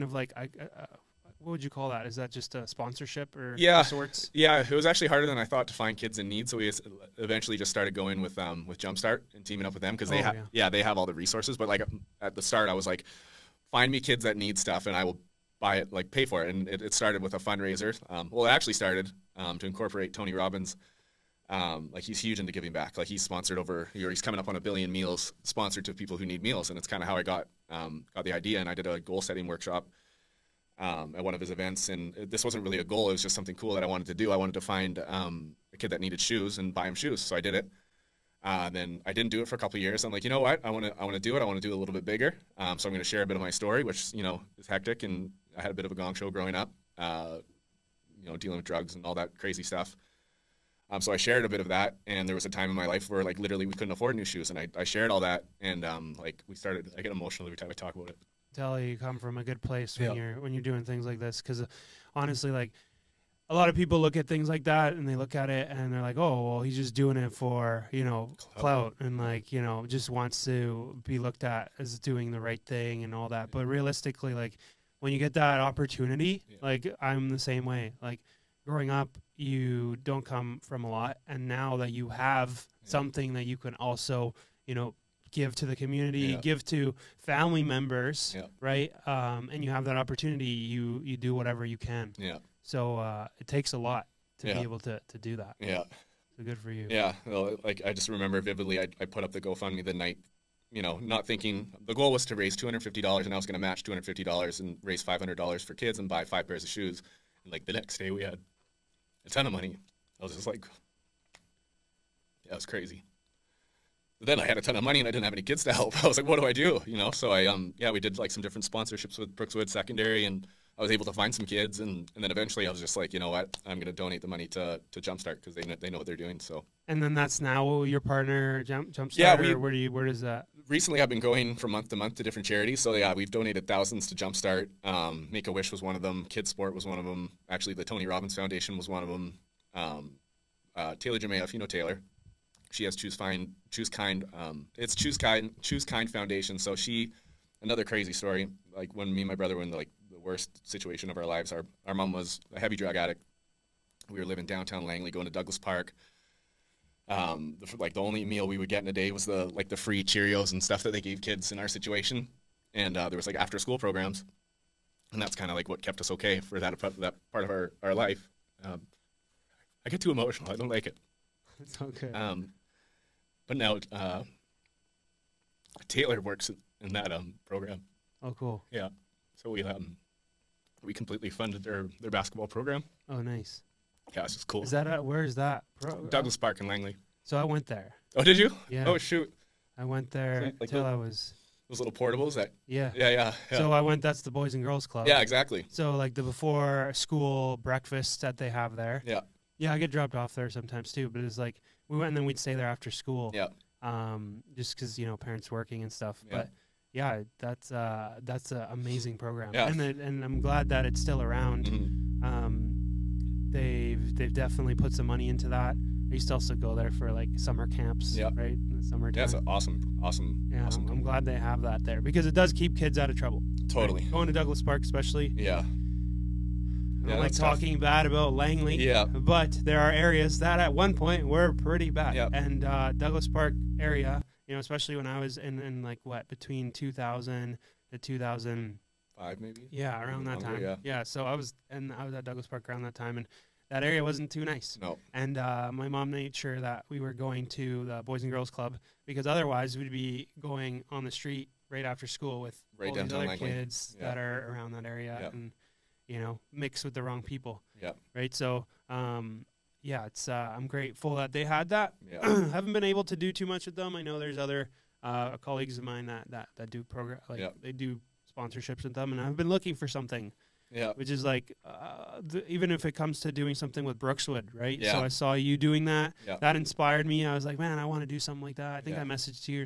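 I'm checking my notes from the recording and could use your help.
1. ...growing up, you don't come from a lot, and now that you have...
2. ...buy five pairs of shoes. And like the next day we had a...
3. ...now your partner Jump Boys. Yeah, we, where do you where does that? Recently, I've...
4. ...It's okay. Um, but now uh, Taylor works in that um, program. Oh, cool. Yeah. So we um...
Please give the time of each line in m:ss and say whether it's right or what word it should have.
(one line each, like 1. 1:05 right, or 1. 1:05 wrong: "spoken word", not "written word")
1. 1:18 right
2. 1:46 right
3. 2:07 wrong: "Jumpstart", not "Boys"
4. 2:51 right.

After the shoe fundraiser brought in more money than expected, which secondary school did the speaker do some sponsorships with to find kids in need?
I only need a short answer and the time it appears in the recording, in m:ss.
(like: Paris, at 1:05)
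Brookswood Secondary, at 1:59.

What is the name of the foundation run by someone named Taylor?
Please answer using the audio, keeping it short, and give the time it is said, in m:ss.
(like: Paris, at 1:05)
Choose Kind Foundation, at 2:25.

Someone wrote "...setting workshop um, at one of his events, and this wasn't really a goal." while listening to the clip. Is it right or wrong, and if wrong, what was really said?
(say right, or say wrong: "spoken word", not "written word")
right.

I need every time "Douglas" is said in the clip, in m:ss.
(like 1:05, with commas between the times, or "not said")
2:35, 3:06, 3:44, 3:52, 4:02.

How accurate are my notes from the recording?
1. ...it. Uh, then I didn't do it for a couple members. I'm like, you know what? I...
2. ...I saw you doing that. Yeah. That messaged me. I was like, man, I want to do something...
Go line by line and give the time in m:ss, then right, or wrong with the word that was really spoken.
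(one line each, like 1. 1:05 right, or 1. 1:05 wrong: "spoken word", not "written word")
1. 0:37 wrong: "years", not "members"
2. 4:35 wrong: "inspired", not "messaged".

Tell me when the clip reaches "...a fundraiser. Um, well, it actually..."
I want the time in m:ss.
0:17.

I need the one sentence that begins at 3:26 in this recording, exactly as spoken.
but yeah, that's uh, that's an amazing program, yeah.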